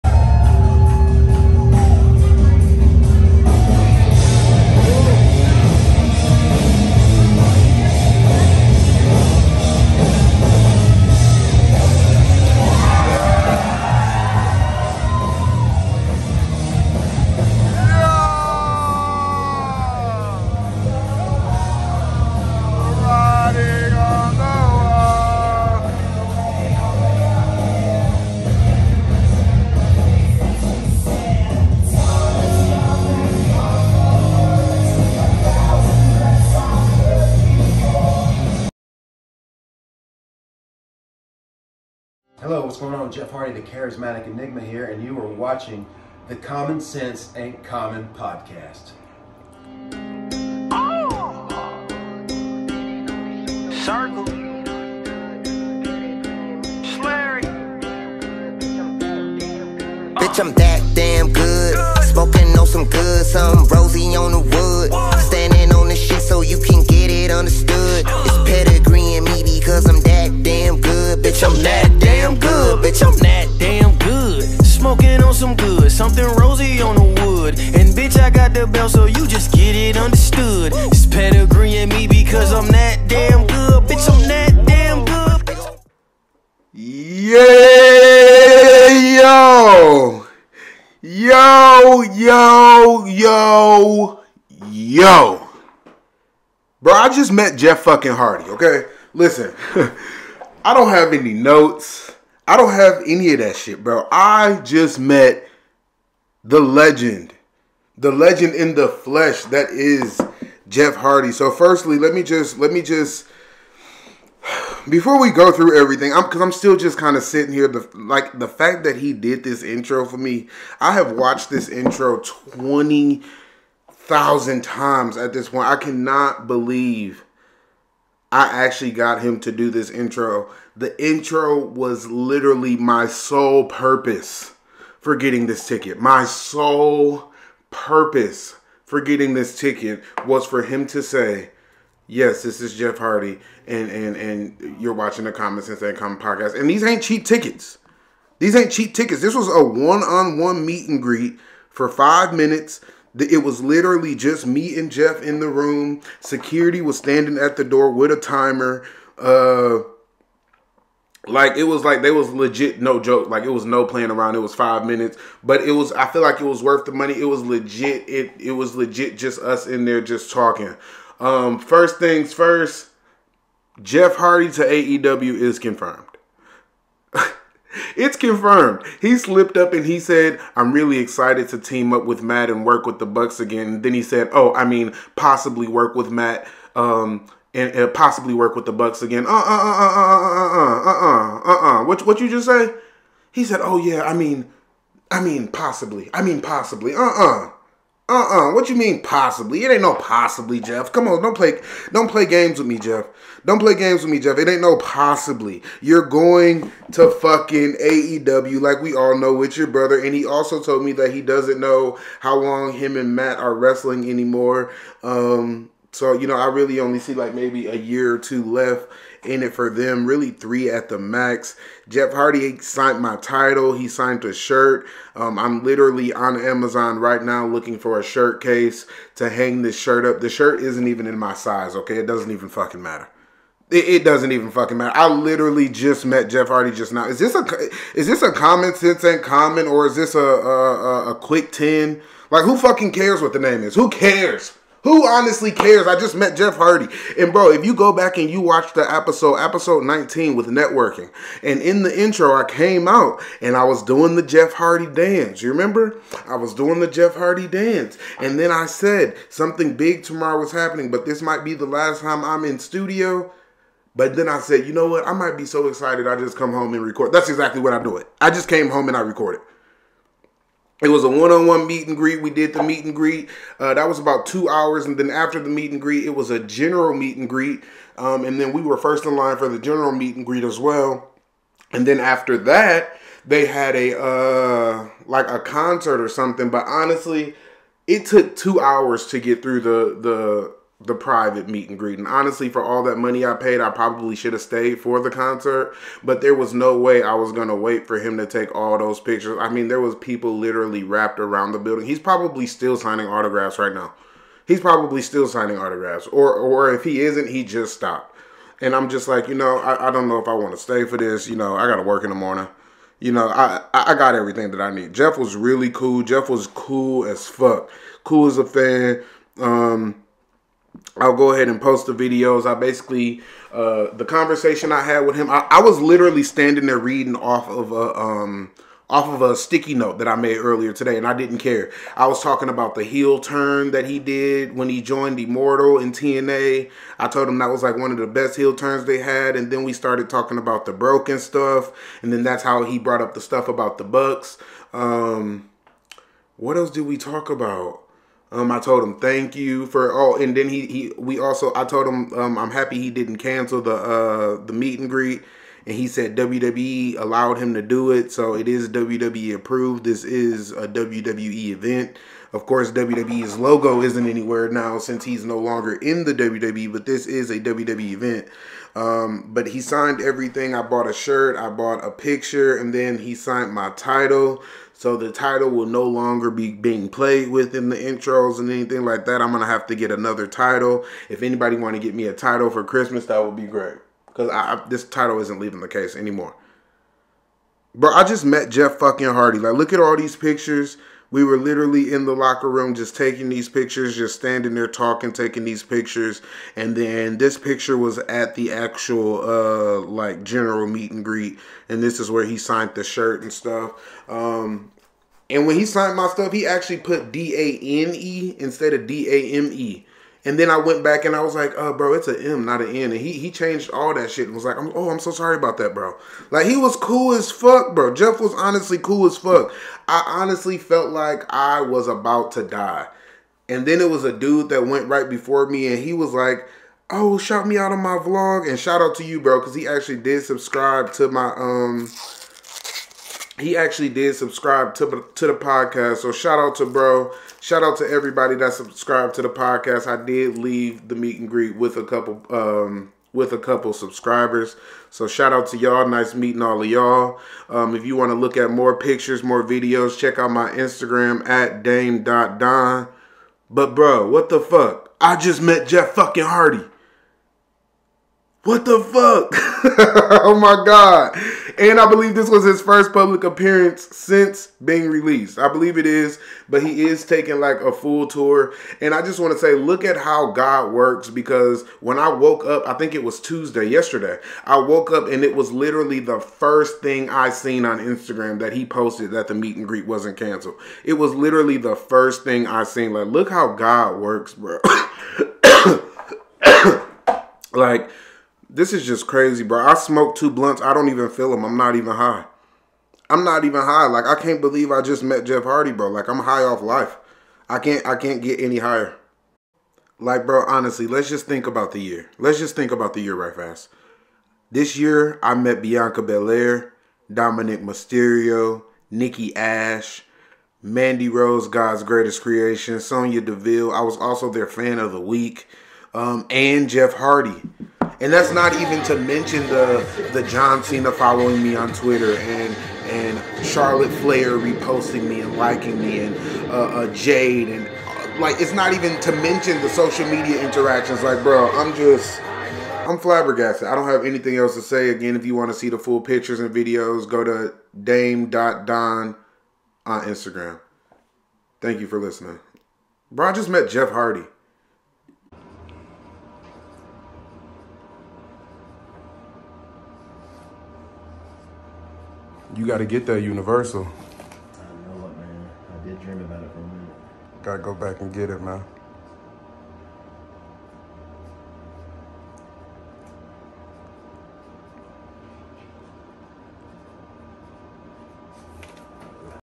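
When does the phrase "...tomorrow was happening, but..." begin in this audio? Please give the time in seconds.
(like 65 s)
260 s.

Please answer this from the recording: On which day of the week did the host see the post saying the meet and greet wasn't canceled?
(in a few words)
Tuesday.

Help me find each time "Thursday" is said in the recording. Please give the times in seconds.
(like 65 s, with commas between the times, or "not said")
not said.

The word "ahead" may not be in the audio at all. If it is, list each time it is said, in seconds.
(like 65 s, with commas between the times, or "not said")
321 s.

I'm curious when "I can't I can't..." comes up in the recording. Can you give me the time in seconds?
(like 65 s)
497 s.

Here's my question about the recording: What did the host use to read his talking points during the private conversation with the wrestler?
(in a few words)
A sticky note.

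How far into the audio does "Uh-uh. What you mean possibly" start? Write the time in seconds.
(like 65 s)
198 s.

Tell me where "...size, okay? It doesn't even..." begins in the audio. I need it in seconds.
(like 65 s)
231 s.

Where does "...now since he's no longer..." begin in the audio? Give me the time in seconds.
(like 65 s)
364 s.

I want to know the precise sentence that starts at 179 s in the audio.
He slipped up and he said, I'm really excited to team up with Matt and work with the Bucks again.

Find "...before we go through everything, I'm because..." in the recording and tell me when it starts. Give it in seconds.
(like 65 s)
114 s.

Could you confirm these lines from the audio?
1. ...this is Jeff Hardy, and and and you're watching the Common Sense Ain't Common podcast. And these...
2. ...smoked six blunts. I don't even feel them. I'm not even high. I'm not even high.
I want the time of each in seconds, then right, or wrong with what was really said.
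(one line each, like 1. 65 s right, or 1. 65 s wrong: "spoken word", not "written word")
1. 142 s right
2. 489 s wrong: "two", not "six".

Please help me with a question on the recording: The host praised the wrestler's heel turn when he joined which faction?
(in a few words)
Immortal.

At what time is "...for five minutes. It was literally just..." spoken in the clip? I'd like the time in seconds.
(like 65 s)
151 s.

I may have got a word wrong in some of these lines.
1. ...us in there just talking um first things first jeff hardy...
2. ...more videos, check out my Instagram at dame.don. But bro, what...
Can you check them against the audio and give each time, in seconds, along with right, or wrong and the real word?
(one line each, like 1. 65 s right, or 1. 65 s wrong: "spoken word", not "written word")
1. 169 s right
2. 449 s right.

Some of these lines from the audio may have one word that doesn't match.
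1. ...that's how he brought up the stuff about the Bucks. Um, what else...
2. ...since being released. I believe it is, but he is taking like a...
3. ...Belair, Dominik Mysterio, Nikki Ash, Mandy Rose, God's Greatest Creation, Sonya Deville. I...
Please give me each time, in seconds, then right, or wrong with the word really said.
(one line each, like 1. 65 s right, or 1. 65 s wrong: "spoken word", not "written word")
1. 342 s right
2. 463 s right
3. 506 s right.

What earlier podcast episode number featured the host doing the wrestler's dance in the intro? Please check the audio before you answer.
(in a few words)
19.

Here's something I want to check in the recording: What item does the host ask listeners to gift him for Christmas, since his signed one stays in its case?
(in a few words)
A title.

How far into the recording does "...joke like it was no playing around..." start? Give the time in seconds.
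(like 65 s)
162 s.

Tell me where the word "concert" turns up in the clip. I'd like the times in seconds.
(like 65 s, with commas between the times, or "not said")
285 s, 295 s.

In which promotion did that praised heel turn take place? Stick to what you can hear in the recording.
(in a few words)
TNA.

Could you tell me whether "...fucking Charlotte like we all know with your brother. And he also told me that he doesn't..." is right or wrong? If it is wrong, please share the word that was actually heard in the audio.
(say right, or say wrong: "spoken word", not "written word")
wrong: "AEW", not "Charlotte".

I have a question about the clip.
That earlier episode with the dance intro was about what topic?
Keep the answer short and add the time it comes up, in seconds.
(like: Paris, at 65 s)
Networking, at 250 s.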